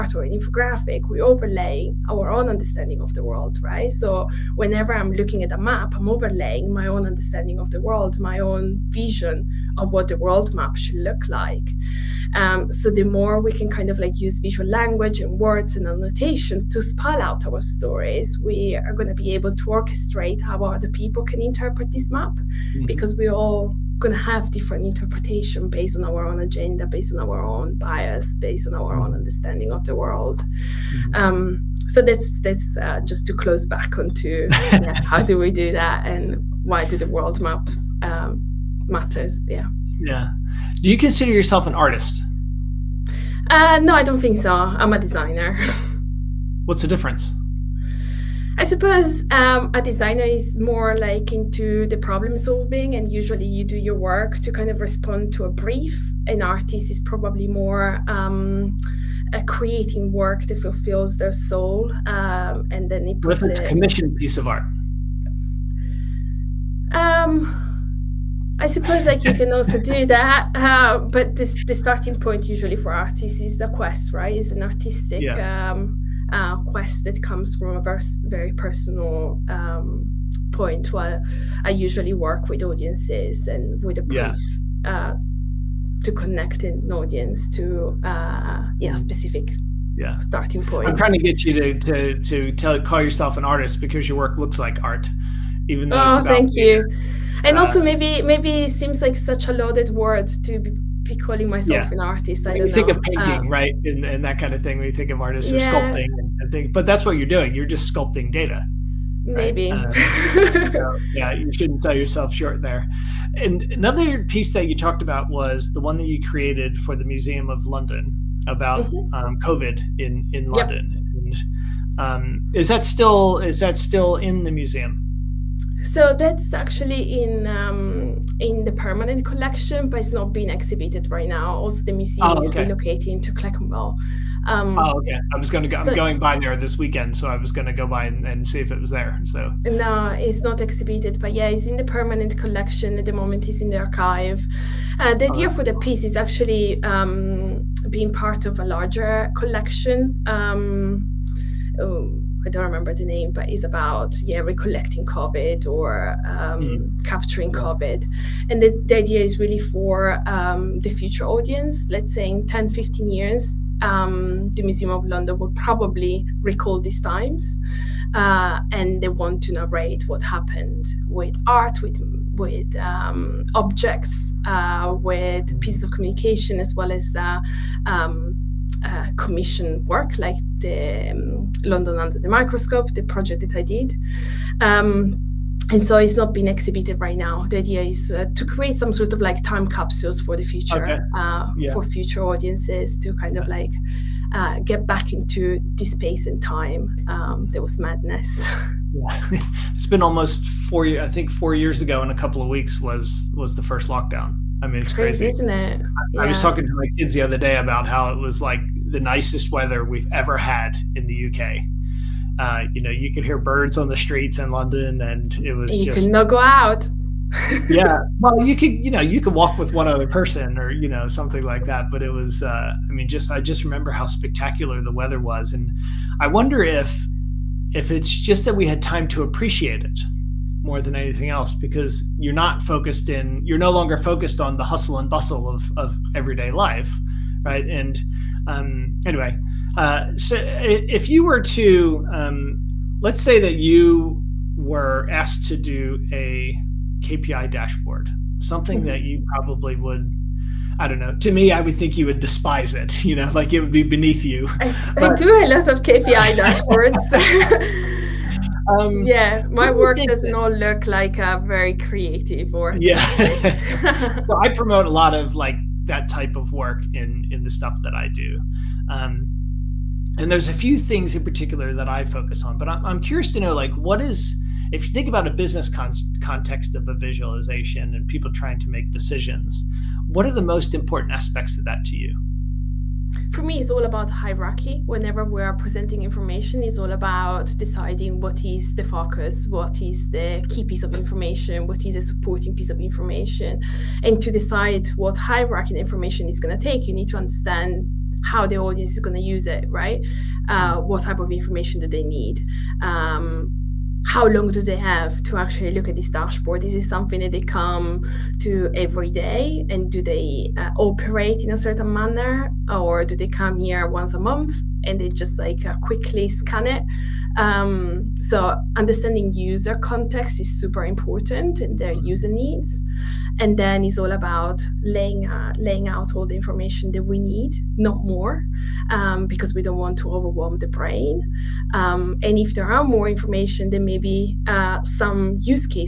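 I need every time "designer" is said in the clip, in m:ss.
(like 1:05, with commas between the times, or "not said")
0:44, 0:49.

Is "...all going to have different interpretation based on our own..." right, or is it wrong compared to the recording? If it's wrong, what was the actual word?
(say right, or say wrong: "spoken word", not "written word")
right.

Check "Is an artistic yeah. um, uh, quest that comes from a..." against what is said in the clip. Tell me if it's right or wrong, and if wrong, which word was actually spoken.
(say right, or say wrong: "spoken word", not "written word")
right.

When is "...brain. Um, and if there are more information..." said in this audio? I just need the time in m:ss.
5:30.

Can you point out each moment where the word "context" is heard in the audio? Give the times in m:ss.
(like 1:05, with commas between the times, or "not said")
4:36, 5:19.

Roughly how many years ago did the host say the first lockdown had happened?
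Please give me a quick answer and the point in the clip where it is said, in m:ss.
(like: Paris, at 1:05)
4, at 3:21.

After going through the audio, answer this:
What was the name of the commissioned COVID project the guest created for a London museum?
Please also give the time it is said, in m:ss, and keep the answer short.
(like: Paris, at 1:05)
London Under the Microscope, at 3:01.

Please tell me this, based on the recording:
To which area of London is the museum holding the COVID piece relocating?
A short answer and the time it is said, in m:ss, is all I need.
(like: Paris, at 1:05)
Clerkenwell, at 2:13.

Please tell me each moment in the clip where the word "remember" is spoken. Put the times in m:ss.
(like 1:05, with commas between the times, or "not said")
2:32, 3:43.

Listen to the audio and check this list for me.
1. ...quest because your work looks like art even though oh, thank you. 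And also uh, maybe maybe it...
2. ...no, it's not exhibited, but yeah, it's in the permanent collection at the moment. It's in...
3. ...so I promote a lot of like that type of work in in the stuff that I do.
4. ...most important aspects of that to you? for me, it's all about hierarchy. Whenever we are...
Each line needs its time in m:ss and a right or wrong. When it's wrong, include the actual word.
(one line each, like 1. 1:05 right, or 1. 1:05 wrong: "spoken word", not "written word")
1. 1:33 wrong: "artist", not "quest"
2. 2:19 right
3. 4:24 right
4. 4:40 right.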